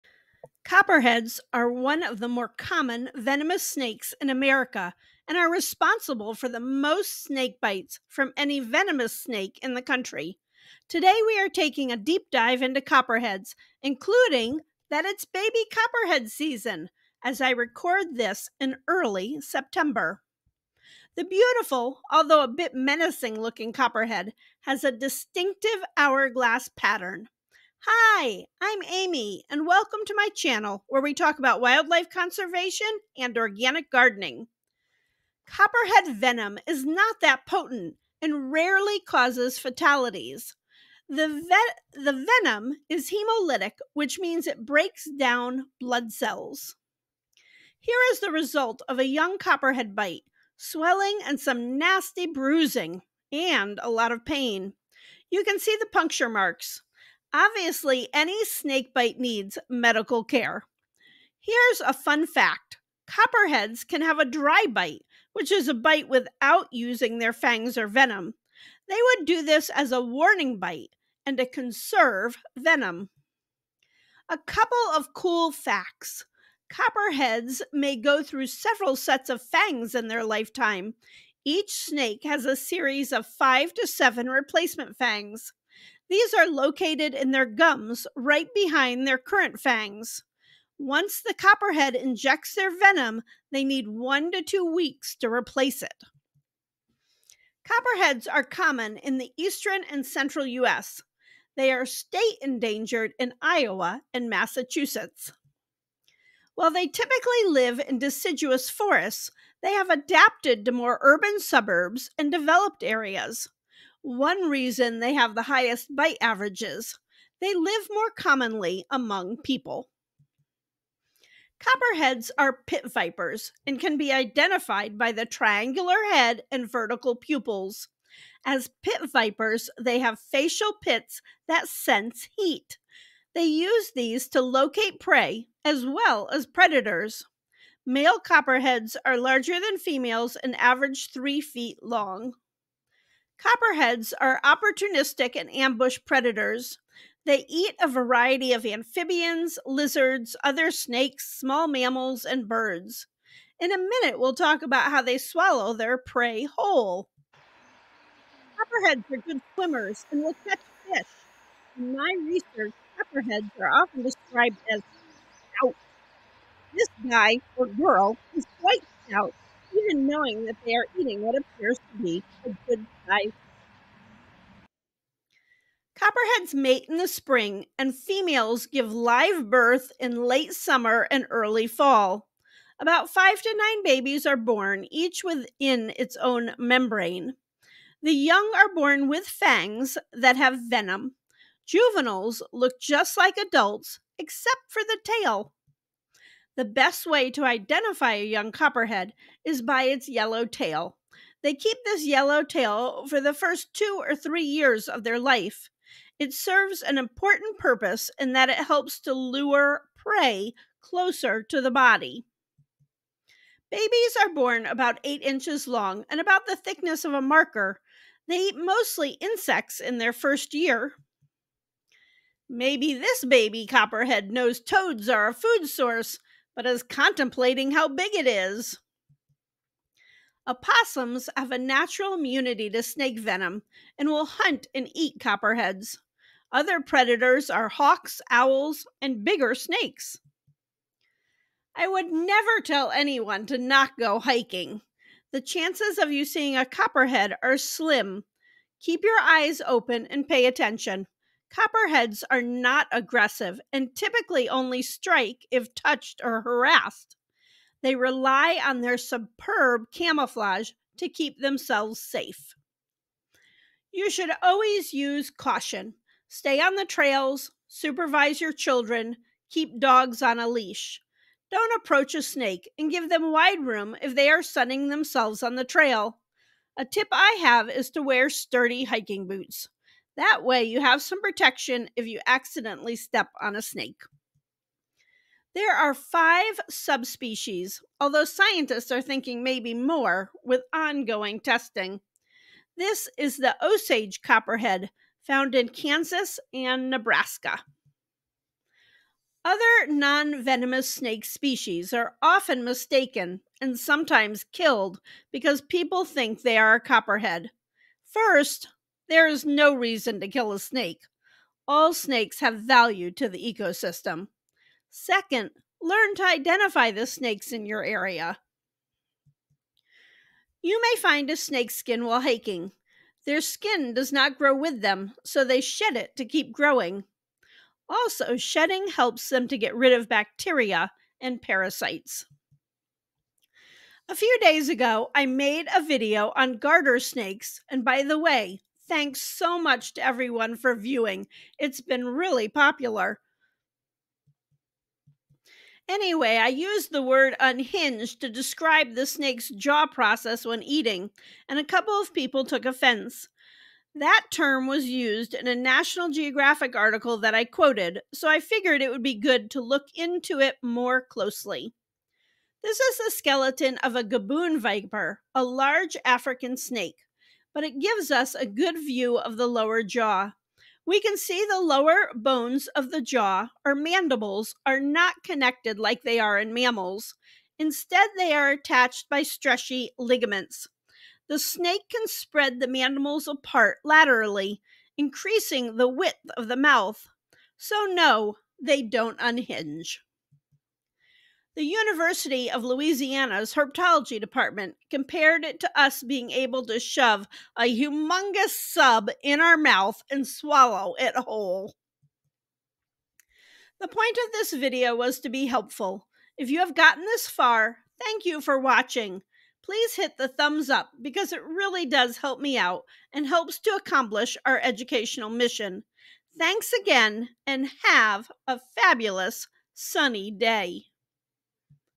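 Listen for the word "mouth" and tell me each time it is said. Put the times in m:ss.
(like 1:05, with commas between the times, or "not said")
6:26, 6:39.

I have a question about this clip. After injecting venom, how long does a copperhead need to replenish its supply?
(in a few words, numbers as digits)
1 to 2 weeks.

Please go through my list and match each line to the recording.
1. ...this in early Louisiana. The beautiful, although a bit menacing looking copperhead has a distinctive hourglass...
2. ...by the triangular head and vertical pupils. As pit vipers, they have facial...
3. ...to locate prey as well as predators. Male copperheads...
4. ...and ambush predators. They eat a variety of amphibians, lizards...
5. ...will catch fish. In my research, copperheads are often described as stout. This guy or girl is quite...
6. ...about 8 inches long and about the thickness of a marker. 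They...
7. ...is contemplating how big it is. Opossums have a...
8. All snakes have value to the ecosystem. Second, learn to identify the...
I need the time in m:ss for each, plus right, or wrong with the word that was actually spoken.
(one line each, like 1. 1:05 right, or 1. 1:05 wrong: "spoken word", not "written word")
1. 0:18 wrong: "September", not "Louisiana"
2. 2:04 right
3. 2:14 right
4. 2:25 right
5. 2:40 right
6. 3:34 right
7. 3:46 right
8. 5:11 right.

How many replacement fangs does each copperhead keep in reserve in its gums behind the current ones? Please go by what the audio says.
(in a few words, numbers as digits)
5 to 7.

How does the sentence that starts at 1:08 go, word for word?
They would do this as a warning bite and to conserve venom.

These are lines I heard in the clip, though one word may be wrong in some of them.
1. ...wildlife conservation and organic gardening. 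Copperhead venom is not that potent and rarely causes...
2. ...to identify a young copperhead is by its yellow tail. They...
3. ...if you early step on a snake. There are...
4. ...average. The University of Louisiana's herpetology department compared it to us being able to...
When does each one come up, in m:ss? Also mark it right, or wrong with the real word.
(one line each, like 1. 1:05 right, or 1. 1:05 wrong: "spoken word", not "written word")
1. 0:31 right
2. 3:17 right
3. 4:41 wrong: "accidentally", not "early"
4. 6:29 wrong: "unhinge", not "average".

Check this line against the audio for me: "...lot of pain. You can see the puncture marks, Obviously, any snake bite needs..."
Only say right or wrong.
right.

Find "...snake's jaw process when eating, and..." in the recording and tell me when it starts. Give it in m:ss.
5:49.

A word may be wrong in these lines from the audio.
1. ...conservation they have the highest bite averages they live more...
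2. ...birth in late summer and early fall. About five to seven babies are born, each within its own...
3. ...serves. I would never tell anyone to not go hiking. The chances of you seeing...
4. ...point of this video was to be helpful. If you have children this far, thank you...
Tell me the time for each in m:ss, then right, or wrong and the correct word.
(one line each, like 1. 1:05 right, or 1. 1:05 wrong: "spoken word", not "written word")
1. 1:54 wrong: "reason", not "conservation"
2. 2:59 wrong: "nine", not "seven"
3. 3:59 wrong: "snakes", not "serves"
4. 6:43 wrong: "gotten", not "children".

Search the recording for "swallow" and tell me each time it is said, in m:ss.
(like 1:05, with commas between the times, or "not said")
2:35, 6:40.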